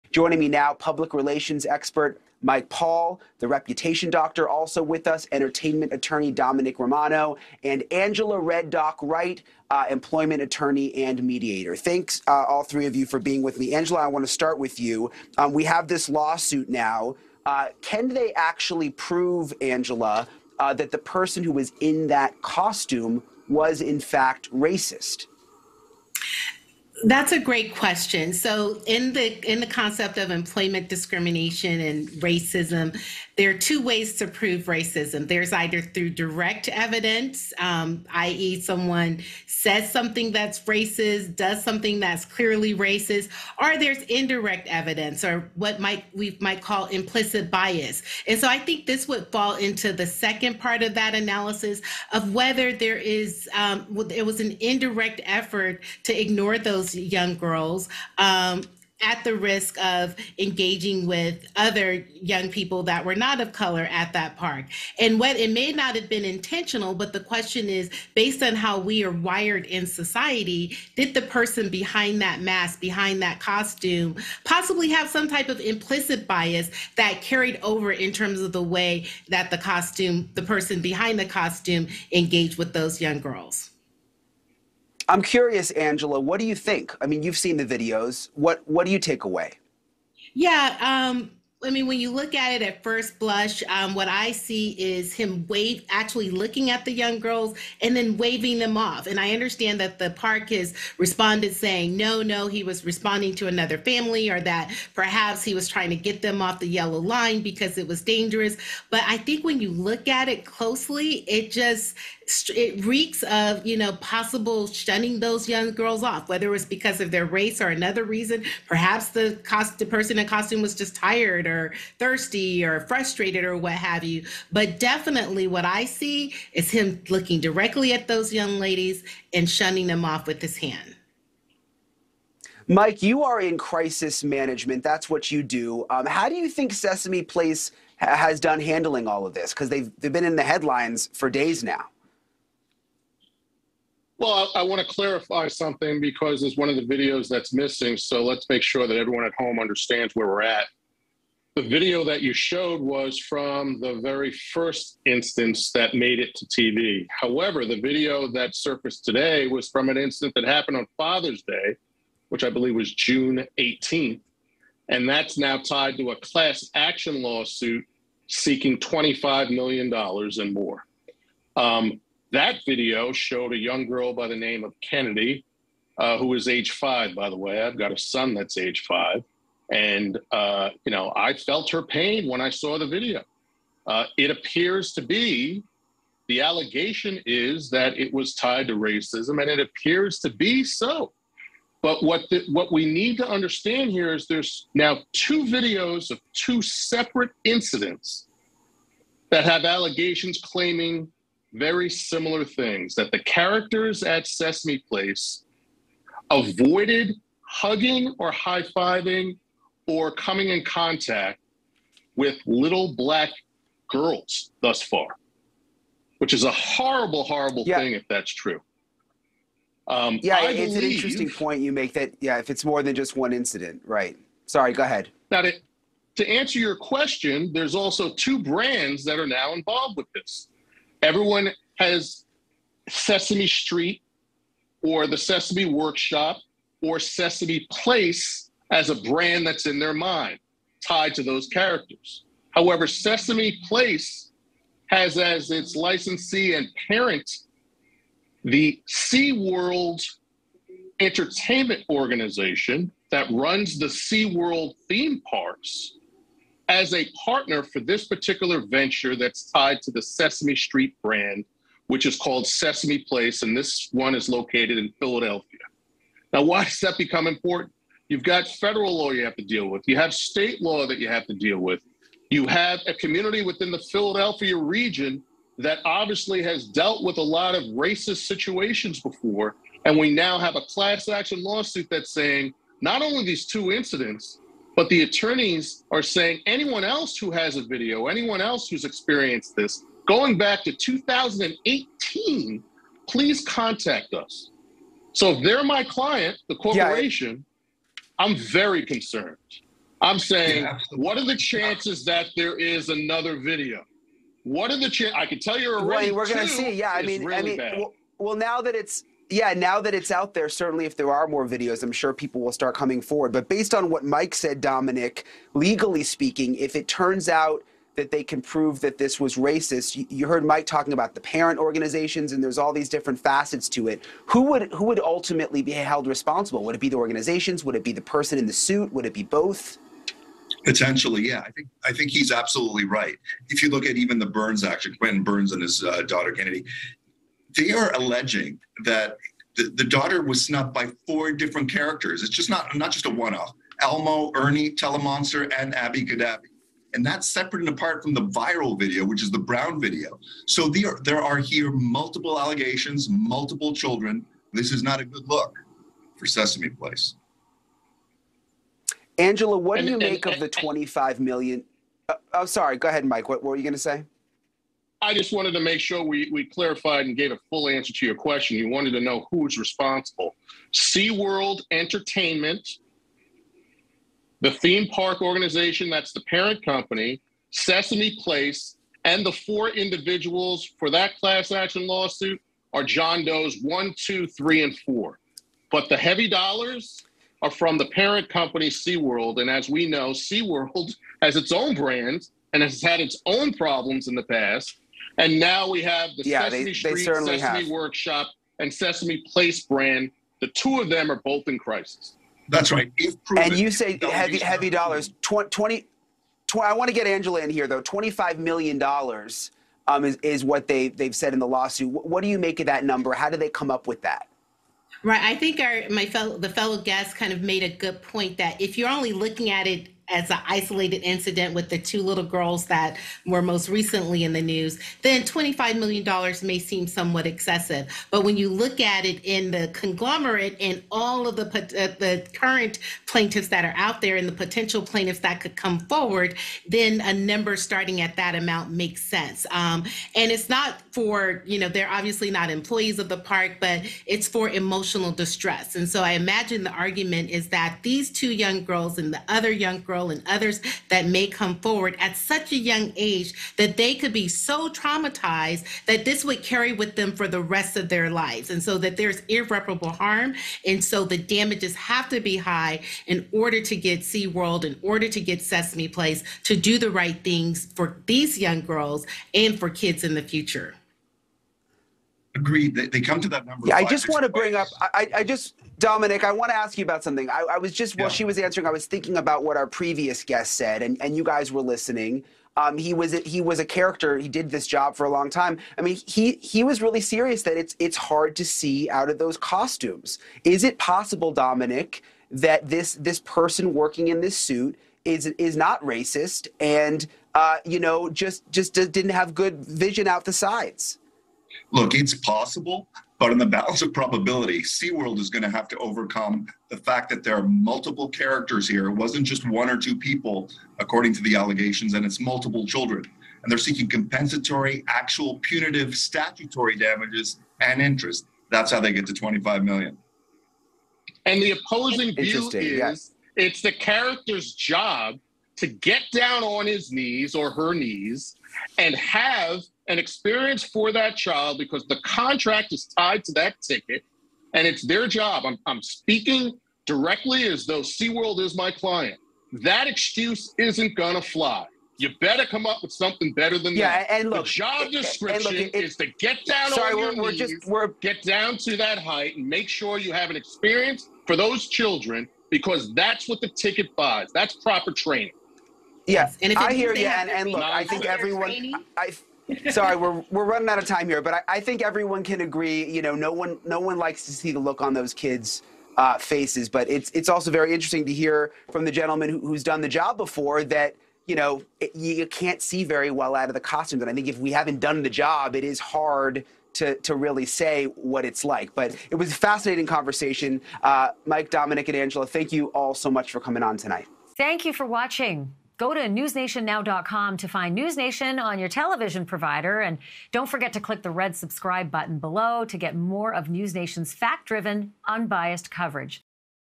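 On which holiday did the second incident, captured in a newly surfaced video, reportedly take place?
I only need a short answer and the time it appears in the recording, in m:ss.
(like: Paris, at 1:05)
Father's Day, at 2:40.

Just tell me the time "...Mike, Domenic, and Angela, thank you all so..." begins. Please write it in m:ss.
9:41.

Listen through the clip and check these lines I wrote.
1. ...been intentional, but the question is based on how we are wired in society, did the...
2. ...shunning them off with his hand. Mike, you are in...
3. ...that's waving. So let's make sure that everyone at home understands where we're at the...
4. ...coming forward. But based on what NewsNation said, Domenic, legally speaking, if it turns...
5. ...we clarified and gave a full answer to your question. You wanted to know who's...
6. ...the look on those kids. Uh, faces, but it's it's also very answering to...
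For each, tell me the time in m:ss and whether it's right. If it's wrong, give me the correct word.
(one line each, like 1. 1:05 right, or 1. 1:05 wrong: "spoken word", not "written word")
1. 1:06 right
2. 2:09 right
3. 2:27 wrong: "missing", not "waving"
4. 5:12 wrong: "Mike", not "NewsNation"
5. 6:06 right
6. 9:24 wrong: "interesting", not "answering".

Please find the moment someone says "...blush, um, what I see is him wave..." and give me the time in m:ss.
1:33.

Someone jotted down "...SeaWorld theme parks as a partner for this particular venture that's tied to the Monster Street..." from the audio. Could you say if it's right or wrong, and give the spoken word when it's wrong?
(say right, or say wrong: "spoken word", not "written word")
wrong: "Sesame", not "Monster".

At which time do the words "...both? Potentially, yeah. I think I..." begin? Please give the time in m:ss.
5:29.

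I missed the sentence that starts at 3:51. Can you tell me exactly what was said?
Everyone has Sesame Street or the Sesame Workshop or Sesame Place as a brand that's in their mind tied to those characters.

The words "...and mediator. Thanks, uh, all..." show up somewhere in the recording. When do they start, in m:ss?
0:10.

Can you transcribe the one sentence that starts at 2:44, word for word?
And that's now tied to a class action lawsuit seeking $25 million and more.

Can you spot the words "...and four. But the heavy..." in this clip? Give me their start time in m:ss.
6:24.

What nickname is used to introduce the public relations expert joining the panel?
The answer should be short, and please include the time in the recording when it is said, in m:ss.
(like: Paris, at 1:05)
the reputation doctor, at 0:03.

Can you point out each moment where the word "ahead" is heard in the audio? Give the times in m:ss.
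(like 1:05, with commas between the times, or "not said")
3:44, 6:02.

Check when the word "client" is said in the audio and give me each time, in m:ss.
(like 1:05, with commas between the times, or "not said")
4:55, 8:58.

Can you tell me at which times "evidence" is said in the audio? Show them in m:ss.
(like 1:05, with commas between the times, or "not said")
0:36, 0:44.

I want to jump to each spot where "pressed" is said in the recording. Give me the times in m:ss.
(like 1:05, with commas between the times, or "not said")
not said.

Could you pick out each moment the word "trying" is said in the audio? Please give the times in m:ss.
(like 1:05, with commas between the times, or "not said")
1:45.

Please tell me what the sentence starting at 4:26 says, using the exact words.
Now, why does that become important?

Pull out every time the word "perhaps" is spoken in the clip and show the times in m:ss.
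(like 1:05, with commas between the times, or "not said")
1:44, 1:58.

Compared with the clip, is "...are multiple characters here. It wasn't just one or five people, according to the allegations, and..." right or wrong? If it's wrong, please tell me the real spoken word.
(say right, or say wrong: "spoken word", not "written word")
wrong: "two", not "five".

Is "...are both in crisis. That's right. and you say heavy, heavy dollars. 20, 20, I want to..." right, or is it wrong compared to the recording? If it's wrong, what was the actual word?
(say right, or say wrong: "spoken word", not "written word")
right.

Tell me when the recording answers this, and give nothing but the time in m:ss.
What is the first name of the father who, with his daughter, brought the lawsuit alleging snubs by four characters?
5:34.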